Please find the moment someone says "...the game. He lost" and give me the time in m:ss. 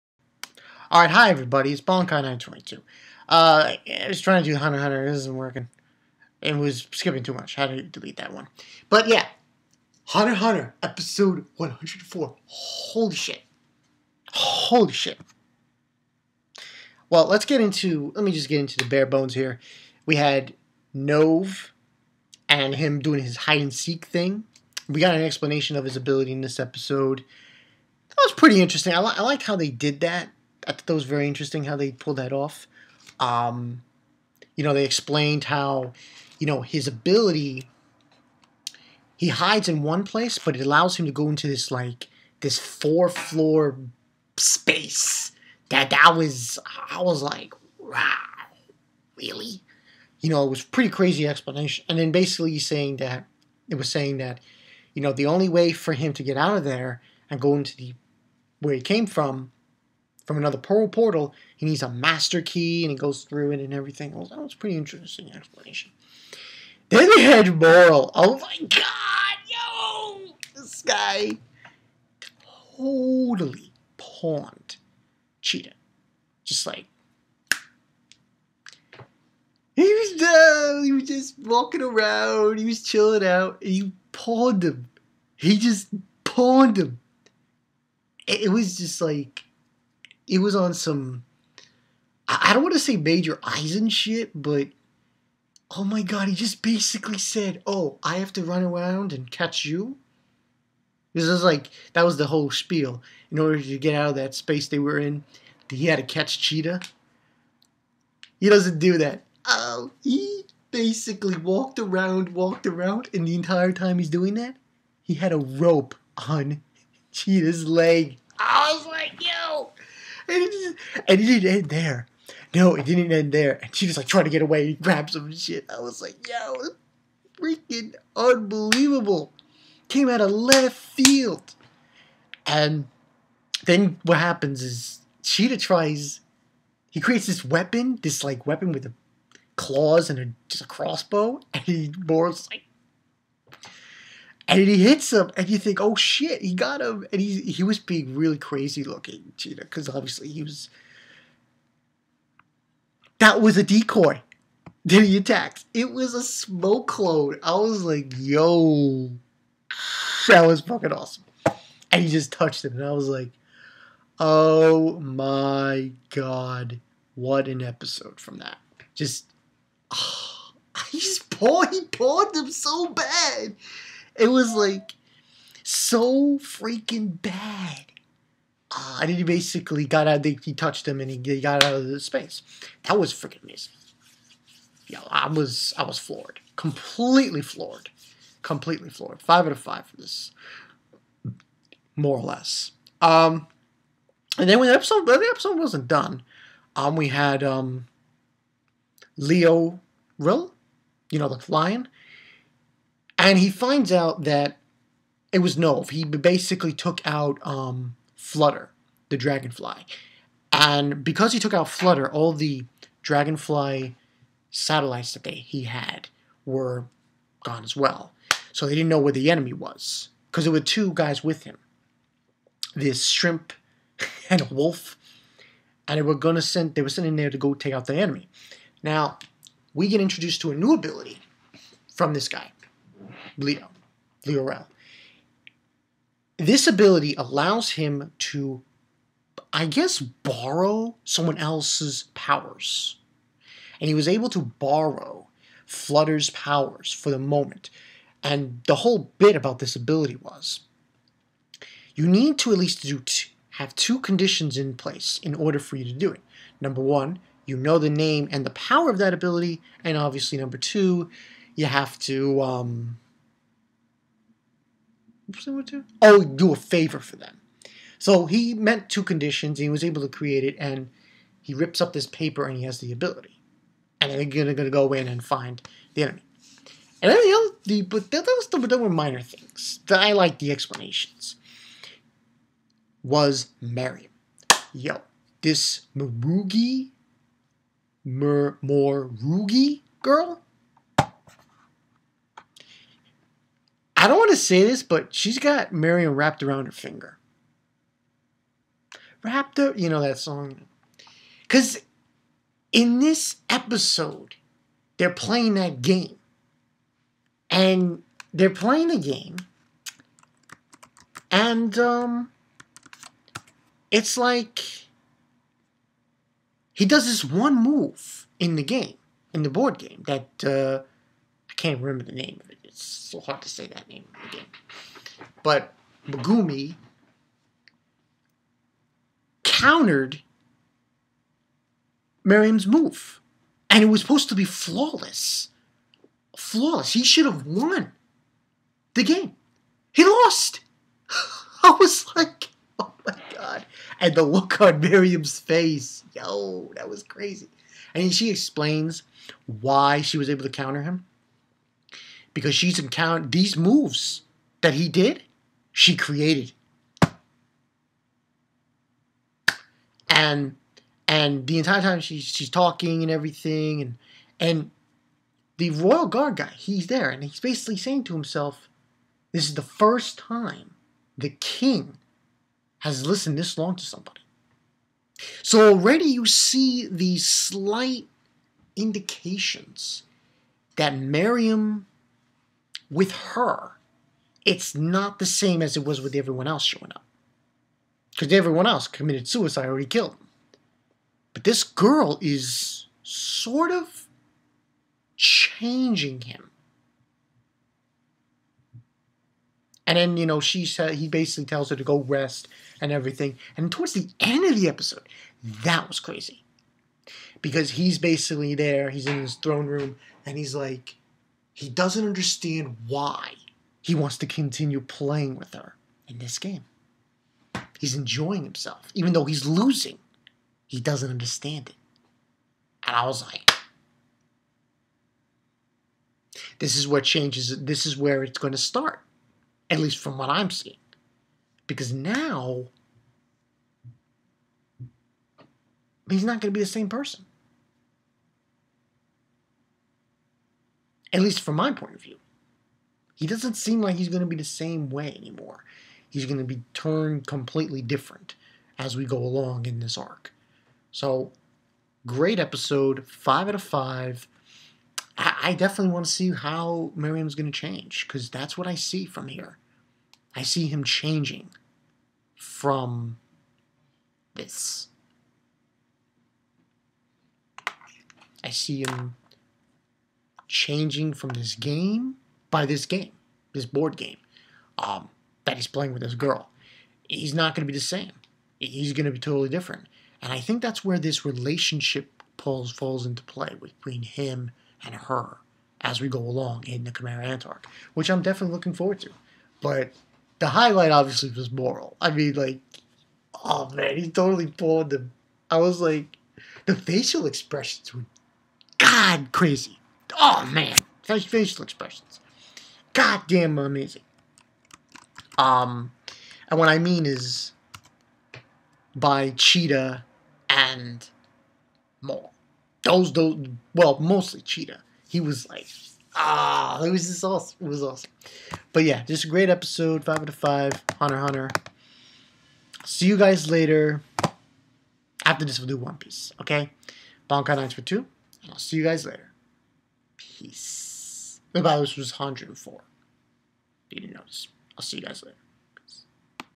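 5:38.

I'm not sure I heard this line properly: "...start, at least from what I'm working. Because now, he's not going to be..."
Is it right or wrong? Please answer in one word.
wrong.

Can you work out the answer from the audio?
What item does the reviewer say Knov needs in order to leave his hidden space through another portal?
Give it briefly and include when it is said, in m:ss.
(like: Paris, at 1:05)
Master key, at 1:01.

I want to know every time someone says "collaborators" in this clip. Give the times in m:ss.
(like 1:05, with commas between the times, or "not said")
not said.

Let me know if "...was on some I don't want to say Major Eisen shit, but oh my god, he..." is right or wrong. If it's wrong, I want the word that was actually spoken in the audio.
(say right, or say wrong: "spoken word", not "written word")
right.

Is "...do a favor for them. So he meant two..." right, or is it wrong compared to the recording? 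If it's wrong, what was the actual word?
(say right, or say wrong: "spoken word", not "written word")
right.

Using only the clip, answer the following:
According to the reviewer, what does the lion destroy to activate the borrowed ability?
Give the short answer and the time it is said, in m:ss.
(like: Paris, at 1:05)
Paper, at 4:32.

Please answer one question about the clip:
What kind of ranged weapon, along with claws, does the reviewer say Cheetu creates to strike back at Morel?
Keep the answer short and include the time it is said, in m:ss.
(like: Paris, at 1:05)
Crossbow, at 2:20.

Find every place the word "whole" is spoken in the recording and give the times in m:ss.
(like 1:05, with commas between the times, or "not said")
1:42, 4:08.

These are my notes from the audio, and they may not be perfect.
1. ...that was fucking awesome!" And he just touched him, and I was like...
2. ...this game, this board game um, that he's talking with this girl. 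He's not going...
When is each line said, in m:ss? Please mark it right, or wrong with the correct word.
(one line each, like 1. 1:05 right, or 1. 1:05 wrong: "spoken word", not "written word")
1. 2:40 right
2. 7:52 wrong: "playing", not "talking".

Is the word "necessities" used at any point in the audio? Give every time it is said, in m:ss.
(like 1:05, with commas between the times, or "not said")
not said.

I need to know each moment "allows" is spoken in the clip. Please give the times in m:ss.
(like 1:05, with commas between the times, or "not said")
0:40, 3:57.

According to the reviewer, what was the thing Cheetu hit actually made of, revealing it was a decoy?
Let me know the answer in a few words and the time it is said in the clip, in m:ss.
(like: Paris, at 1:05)
Smoke clone, at 2:36.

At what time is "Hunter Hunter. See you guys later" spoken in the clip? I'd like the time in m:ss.
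8:40.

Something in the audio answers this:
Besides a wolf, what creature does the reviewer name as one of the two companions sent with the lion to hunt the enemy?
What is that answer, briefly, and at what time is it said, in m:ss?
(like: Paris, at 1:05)
Shrimp, at 3:43.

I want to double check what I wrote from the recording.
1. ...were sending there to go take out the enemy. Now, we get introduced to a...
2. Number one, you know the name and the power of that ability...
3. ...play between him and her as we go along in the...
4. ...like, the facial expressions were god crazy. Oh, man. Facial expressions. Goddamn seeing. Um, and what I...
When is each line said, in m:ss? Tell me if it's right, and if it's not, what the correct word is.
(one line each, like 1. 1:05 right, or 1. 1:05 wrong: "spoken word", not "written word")
1. 3:46 right
2. 4:16 right
3. 8:03 right
4. 8:15 wrong: "amazing", not "seeing".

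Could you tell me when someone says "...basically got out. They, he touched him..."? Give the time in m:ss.
2:59.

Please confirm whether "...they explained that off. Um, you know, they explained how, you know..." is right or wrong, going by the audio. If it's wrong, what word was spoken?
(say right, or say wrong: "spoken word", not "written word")
wrong: "pulled", not "explained".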